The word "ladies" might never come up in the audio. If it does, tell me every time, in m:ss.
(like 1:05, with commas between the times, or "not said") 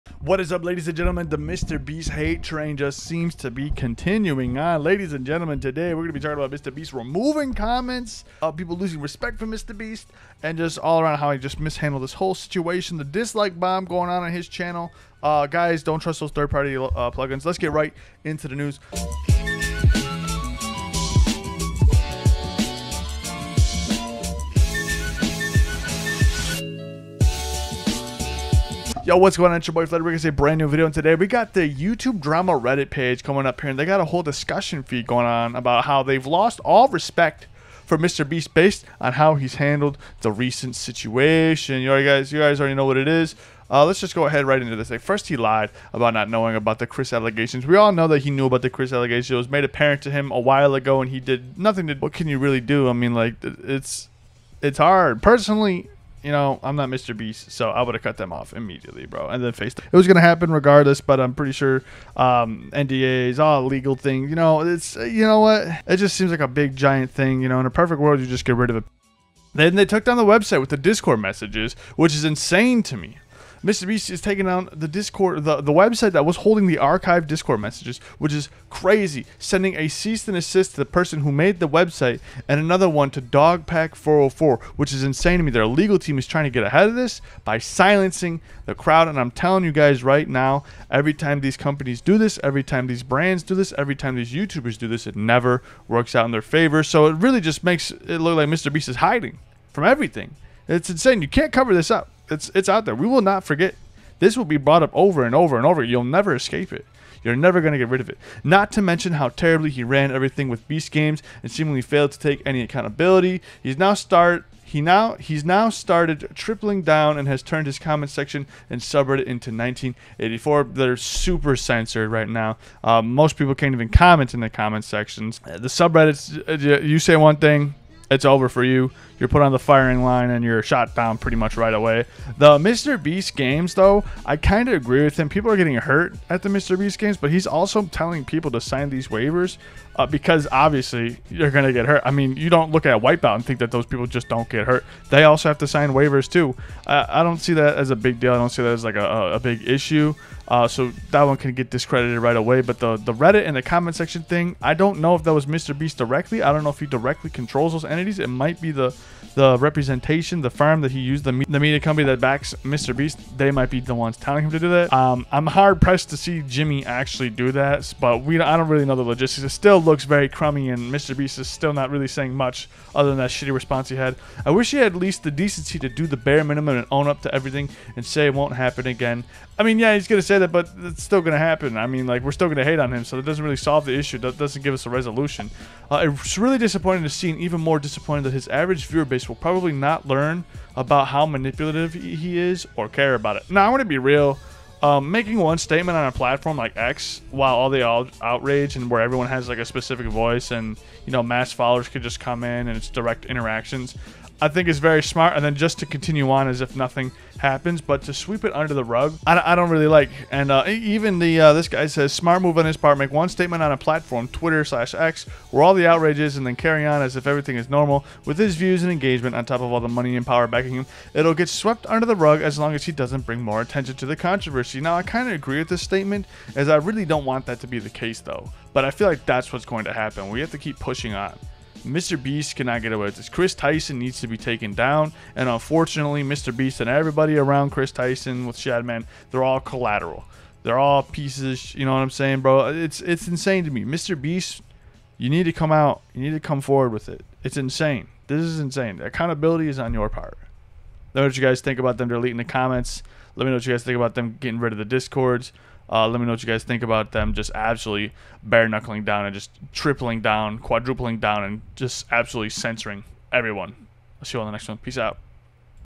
0:00, 0:04.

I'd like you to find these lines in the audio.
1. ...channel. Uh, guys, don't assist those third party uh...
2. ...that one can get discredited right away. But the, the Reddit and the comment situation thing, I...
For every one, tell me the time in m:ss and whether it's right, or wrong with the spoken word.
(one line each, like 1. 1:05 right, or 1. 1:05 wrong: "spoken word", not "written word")
1. 0:14 wrong: "trust", not "assist"
2. 2:31 wrong: "section", not "situation".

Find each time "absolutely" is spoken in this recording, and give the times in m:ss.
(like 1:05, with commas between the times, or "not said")
4:17, 4:22.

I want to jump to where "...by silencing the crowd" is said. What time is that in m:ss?
1:27.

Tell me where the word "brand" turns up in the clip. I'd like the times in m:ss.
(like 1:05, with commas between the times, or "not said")
0:30, 1:33.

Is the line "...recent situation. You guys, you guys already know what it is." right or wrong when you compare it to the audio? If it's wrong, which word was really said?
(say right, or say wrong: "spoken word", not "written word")
right.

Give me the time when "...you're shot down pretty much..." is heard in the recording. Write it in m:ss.
2:10.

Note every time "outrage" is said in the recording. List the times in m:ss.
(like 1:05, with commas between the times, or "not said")
3:18, 3:35.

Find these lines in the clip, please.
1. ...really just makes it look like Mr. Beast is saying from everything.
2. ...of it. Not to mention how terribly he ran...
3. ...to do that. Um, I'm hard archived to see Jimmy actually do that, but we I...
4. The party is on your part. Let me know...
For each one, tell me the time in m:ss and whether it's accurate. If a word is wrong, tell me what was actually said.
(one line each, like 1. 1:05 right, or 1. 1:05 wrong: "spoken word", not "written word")
1. 1:37 wrong: "hiding", not "saying"
2. 1:48 right
3. 2:44 wrong: "pressed", not "archived"
4. 4:08 wrong: "accountability", not "party".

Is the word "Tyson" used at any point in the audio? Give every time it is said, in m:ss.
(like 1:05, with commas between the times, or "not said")
3:53, 3:57.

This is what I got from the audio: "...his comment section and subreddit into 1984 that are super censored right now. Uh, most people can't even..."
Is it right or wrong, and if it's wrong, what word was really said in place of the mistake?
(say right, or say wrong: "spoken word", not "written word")
right.